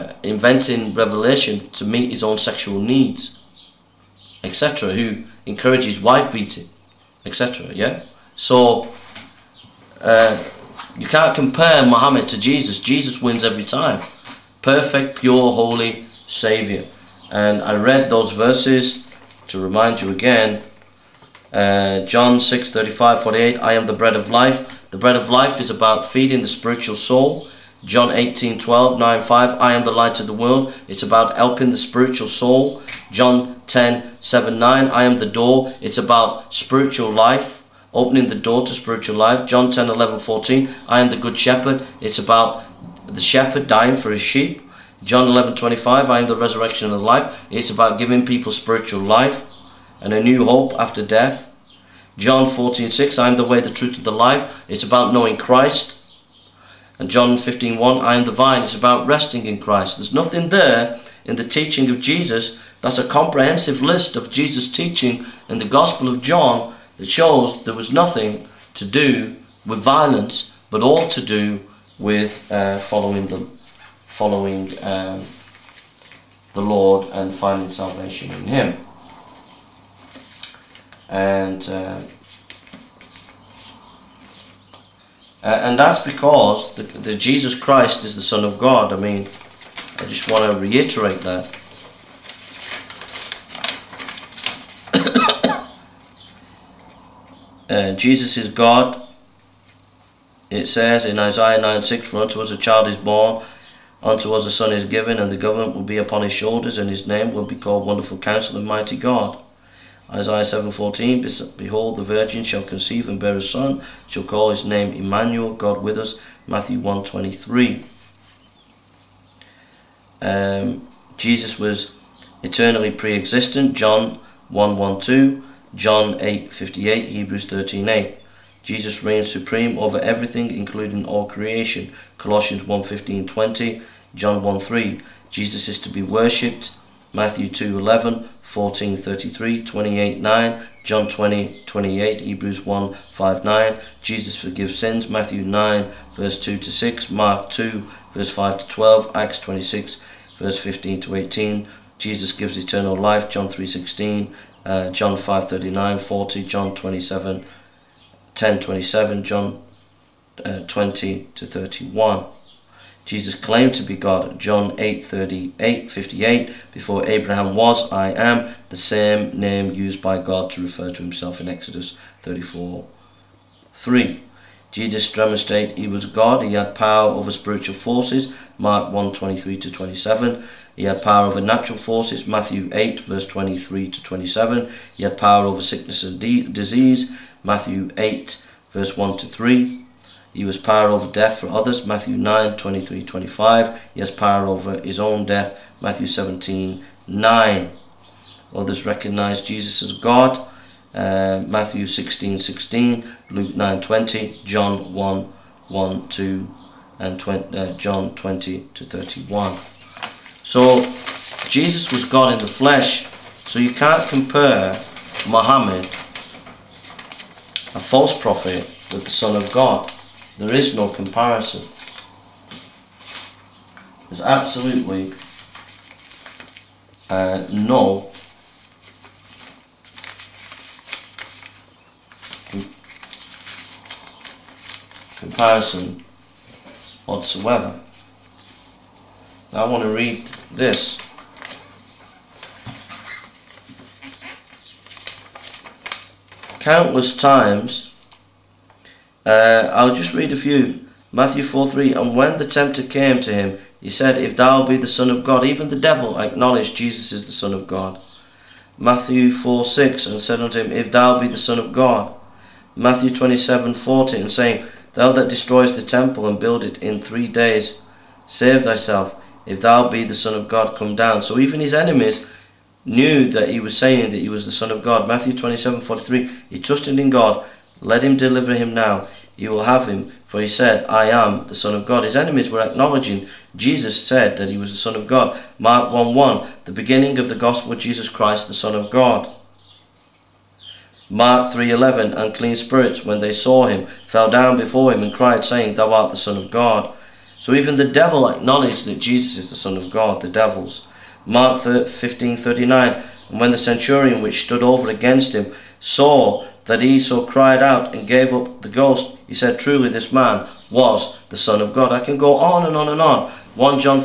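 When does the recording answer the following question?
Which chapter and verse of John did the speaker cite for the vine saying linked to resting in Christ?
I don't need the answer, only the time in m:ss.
0:57.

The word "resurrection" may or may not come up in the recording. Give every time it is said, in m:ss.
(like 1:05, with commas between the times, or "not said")
0:46.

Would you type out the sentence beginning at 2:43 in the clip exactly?
Jesus claimed to be God, John 8 38 58.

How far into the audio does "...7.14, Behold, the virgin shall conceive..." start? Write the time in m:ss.
1:50.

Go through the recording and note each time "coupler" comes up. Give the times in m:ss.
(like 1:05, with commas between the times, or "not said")
not said.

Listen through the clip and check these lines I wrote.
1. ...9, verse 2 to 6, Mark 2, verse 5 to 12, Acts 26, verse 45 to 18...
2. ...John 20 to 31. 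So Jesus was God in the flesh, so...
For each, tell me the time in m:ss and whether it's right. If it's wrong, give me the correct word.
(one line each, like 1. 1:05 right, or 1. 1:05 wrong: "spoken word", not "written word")
1. 2:25 wrong: "15", not "45"
2. 3:27 right.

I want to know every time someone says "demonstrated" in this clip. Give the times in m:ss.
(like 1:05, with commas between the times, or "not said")
2:55.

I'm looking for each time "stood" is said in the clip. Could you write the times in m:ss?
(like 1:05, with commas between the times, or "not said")
5:04.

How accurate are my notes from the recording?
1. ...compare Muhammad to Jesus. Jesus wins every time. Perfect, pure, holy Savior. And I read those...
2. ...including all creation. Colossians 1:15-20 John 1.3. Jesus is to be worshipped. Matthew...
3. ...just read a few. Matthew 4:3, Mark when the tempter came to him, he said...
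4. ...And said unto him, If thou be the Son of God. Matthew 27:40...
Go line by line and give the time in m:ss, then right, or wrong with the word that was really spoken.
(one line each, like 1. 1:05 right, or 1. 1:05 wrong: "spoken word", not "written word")
1. 0:11 right
2. 2:10 right
3. 4:09 wrong: "And", not "Mark"
4. 4:20 right.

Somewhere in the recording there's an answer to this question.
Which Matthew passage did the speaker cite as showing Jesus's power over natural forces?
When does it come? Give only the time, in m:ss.
3:02.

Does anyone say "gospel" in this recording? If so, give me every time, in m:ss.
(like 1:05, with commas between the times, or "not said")
1:05, 4:47.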